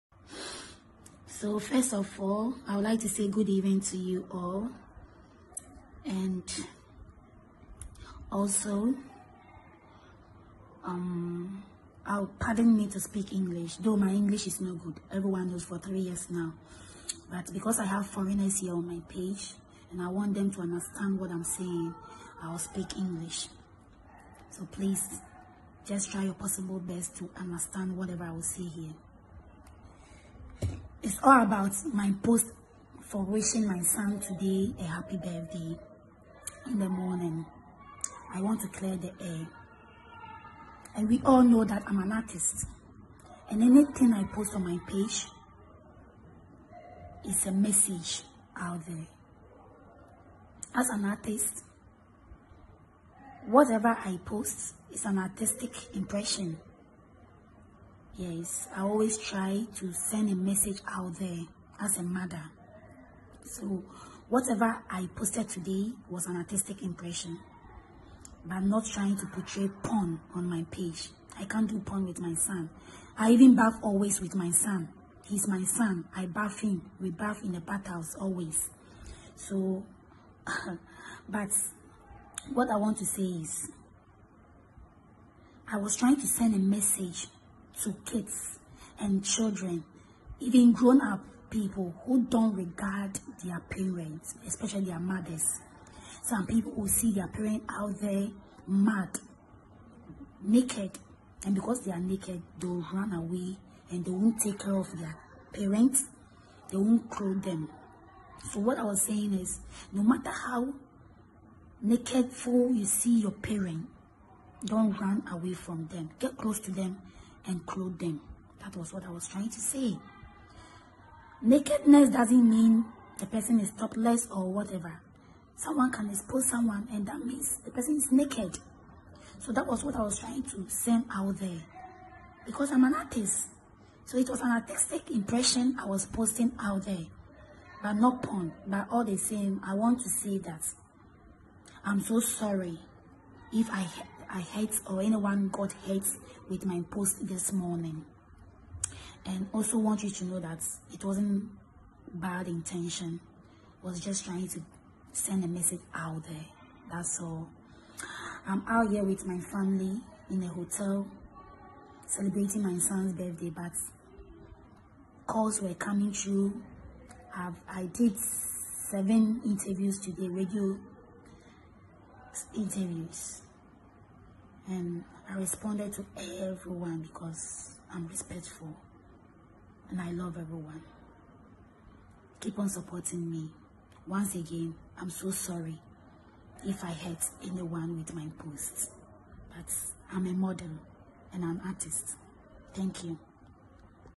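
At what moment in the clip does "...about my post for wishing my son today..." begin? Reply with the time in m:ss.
0:31.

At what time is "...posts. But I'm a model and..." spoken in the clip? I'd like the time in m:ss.
3:08.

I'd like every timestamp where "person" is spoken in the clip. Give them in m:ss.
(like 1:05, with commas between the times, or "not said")
2:03, 2:07.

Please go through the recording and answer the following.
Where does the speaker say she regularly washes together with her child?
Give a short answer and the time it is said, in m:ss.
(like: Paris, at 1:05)
bathhouse, at 1:17.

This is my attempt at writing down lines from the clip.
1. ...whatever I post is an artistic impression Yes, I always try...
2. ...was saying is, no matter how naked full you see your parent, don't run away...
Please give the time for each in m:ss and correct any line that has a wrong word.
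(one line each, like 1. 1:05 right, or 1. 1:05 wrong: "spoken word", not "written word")
1. 0:53 right
2. 1:48 right.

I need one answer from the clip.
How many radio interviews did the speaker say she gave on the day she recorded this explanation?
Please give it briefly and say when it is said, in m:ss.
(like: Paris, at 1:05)
7, at 2:48.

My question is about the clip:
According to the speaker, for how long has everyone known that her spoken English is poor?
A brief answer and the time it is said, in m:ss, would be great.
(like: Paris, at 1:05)
3 years, at 0:15.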